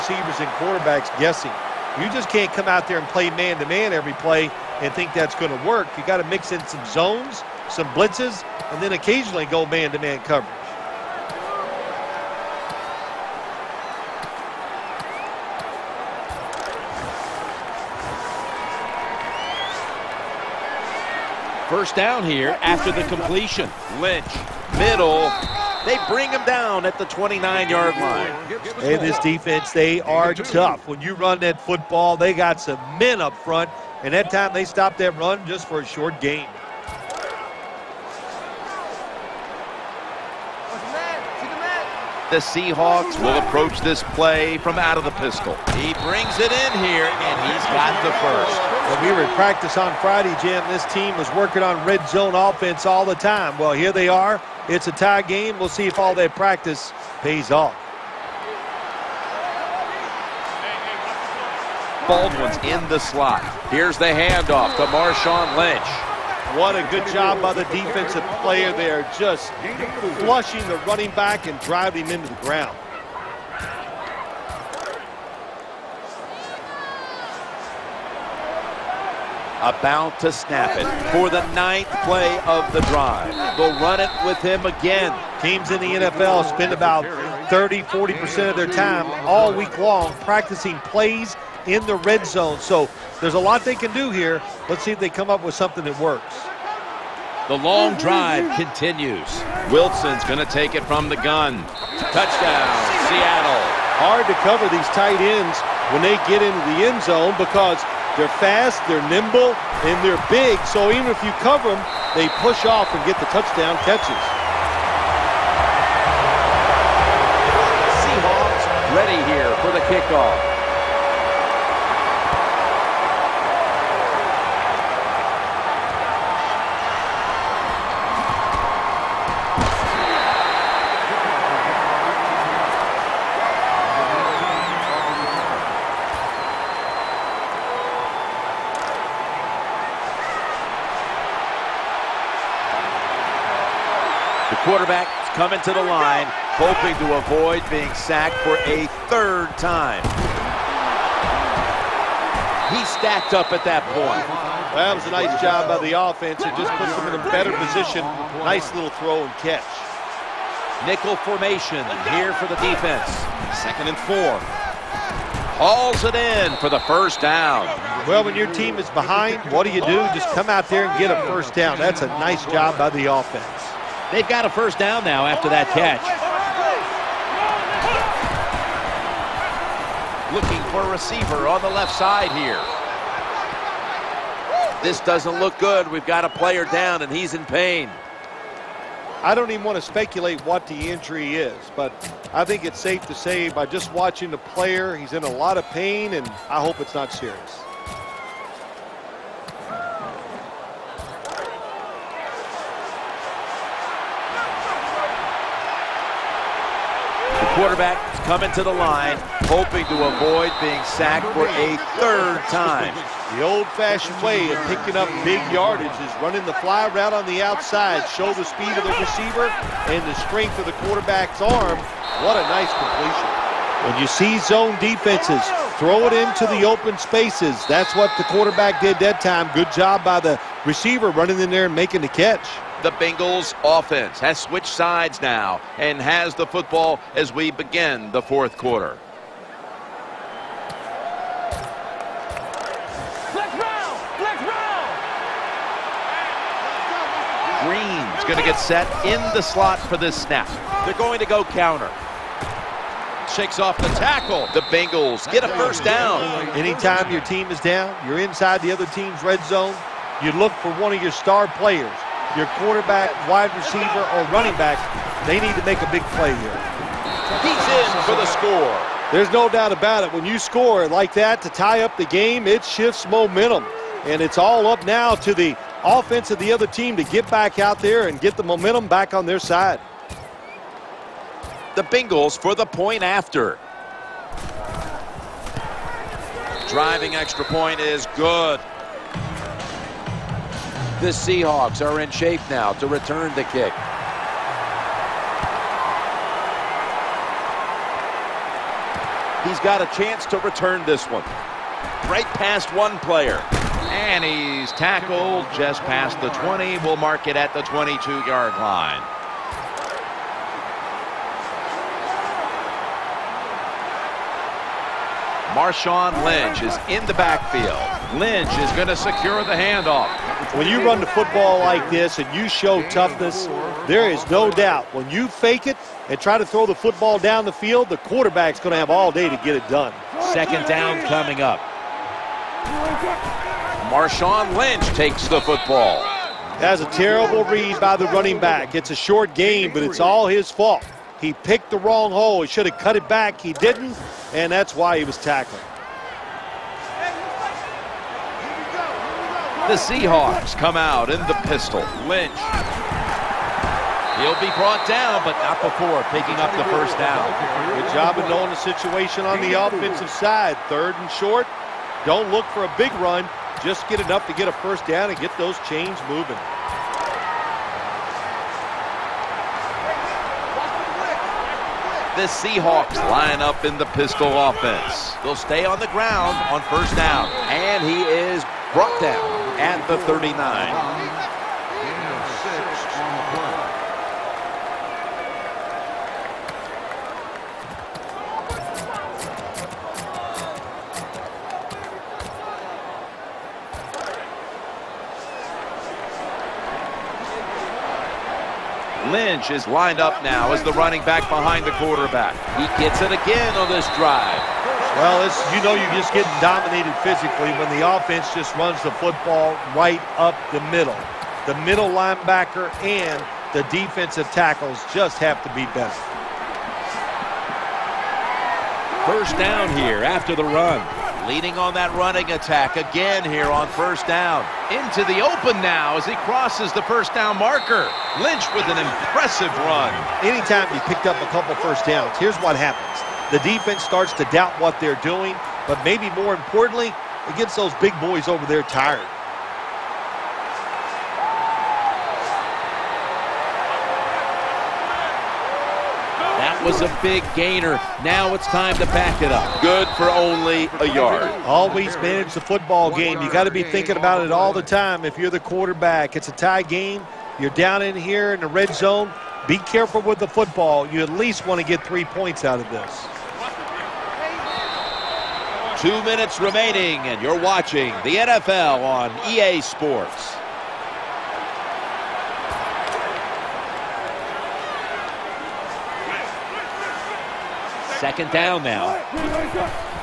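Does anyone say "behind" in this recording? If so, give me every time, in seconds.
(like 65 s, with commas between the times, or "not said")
168 s, 401 s.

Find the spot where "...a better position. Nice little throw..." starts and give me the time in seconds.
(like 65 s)
157 s.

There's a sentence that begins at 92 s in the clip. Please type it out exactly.
So there's a lot they can do here.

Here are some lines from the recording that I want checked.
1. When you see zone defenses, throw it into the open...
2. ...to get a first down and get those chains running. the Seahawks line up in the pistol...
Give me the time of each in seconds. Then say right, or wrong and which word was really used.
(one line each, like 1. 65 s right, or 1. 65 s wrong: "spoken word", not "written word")
1. 223 s right
2. 364 s wrong: "moving", not "running".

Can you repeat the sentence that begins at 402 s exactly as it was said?
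He gets it again on this drive.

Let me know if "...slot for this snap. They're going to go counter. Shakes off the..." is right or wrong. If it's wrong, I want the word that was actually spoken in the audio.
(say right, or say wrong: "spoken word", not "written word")
right.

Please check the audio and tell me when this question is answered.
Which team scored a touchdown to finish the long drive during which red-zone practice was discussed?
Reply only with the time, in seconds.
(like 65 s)
103 s.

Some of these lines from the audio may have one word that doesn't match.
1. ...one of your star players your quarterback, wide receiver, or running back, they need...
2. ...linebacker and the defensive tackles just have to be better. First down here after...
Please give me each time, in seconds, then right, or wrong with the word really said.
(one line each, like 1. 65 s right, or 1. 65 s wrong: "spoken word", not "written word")
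1. 260 s right
2. 411 s right.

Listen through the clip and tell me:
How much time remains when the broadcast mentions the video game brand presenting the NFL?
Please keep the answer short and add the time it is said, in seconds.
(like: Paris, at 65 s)
2 minutes, at 465 s.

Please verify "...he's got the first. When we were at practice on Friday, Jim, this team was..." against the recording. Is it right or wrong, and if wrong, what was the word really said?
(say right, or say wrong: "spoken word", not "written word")
right.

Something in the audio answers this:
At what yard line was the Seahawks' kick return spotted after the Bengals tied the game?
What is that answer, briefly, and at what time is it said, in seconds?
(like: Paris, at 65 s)
22, at 307 s.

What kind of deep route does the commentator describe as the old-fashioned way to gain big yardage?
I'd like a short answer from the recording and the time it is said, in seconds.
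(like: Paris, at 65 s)
Fly route, at 216 s.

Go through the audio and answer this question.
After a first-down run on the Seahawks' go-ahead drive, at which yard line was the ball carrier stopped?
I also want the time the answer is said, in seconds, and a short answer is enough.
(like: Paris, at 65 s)
39, at 379 s.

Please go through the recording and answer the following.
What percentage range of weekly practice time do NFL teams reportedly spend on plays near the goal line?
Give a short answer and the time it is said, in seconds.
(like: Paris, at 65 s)
30-40%, at 87 s.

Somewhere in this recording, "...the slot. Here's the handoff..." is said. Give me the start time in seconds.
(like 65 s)
62 s.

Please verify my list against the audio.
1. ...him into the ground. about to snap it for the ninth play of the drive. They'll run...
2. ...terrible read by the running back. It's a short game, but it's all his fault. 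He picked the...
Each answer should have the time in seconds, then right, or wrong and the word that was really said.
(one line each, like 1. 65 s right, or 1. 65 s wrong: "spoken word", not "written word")
1. 72 s right
2. 336 s right.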